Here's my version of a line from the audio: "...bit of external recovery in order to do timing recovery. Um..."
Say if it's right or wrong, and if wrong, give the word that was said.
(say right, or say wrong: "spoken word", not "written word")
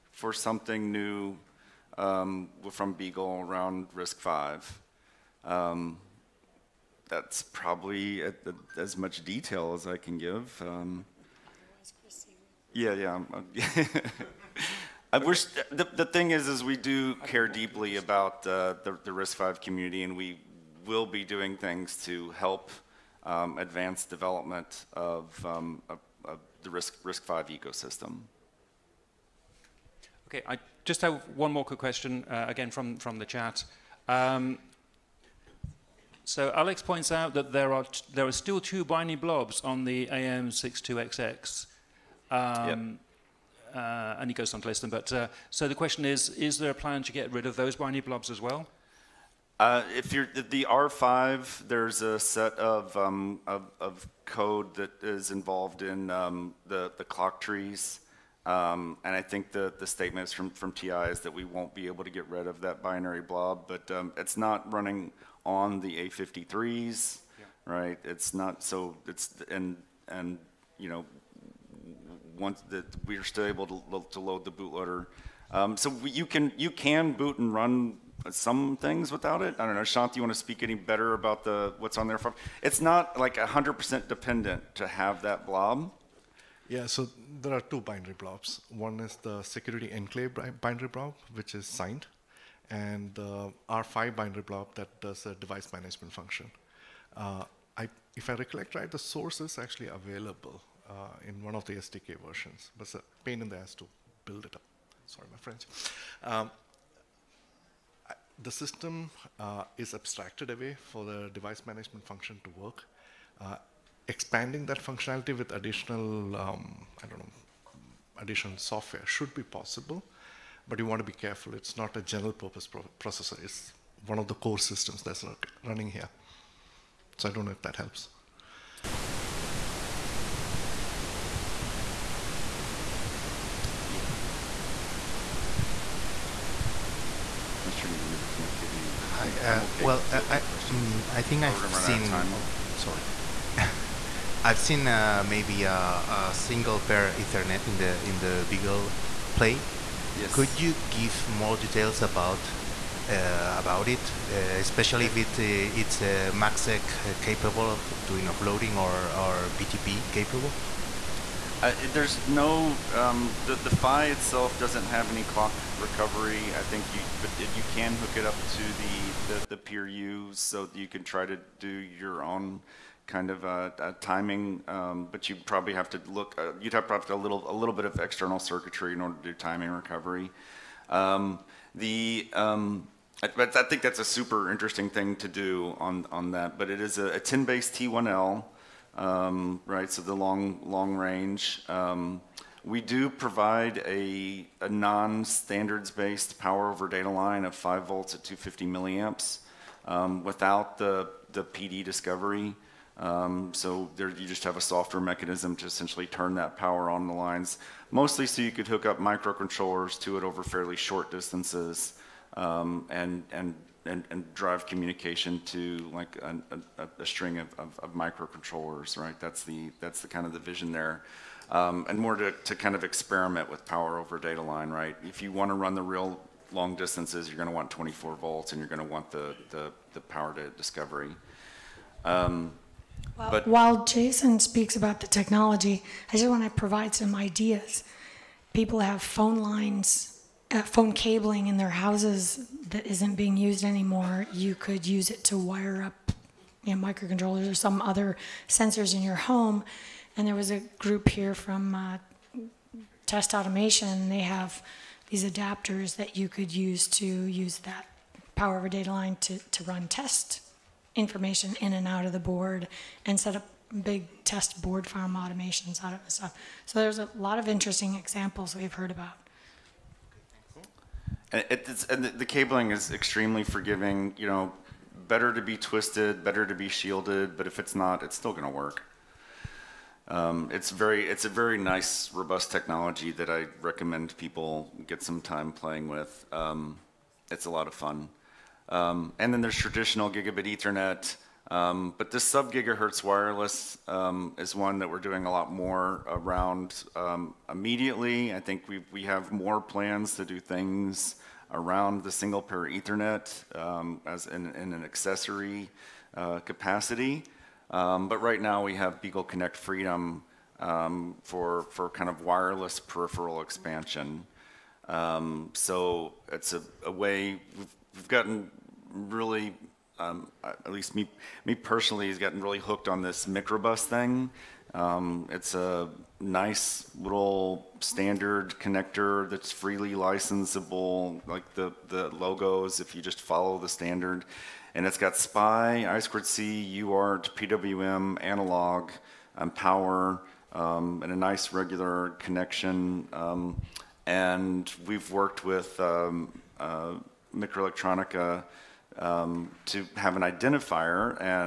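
wrong: "circuitry", not "recovery".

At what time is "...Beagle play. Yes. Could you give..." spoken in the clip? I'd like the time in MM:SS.
02:28.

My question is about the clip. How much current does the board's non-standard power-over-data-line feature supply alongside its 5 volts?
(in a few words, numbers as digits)
250 milliamps.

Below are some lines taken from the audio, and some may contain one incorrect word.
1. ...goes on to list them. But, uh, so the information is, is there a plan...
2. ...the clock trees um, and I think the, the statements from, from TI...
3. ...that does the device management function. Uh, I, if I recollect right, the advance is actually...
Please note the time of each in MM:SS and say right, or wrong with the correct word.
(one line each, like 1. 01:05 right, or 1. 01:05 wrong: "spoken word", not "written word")
1. 00:44 wrong: "question", not "information"
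2. 00:56 right
3. 01:34 wrong: "source", not "advance".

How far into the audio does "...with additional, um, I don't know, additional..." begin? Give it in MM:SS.
01:55.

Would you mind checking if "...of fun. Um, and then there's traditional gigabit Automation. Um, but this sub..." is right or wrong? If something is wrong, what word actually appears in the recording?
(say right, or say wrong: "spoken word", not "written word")
wrong: "Ethernet", not "Automation".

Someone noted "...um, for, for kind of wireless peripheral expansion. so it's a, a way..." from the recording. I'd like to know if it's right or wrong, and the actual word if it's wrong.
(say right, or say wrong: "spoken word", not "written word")
right.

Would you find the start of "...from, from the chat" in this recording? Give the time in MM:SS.
00:32.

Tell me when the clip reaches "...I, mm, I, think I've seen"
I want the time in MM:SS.
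02:20.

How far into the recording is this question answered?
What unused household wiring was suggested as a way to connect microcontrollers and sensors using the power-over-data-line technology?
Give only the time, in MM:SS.
03:59.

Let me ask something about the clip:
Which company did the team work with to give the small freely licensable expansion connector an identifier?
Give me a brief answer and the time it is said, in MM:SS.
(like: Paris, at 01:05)
MikroElektronika, at 05:47.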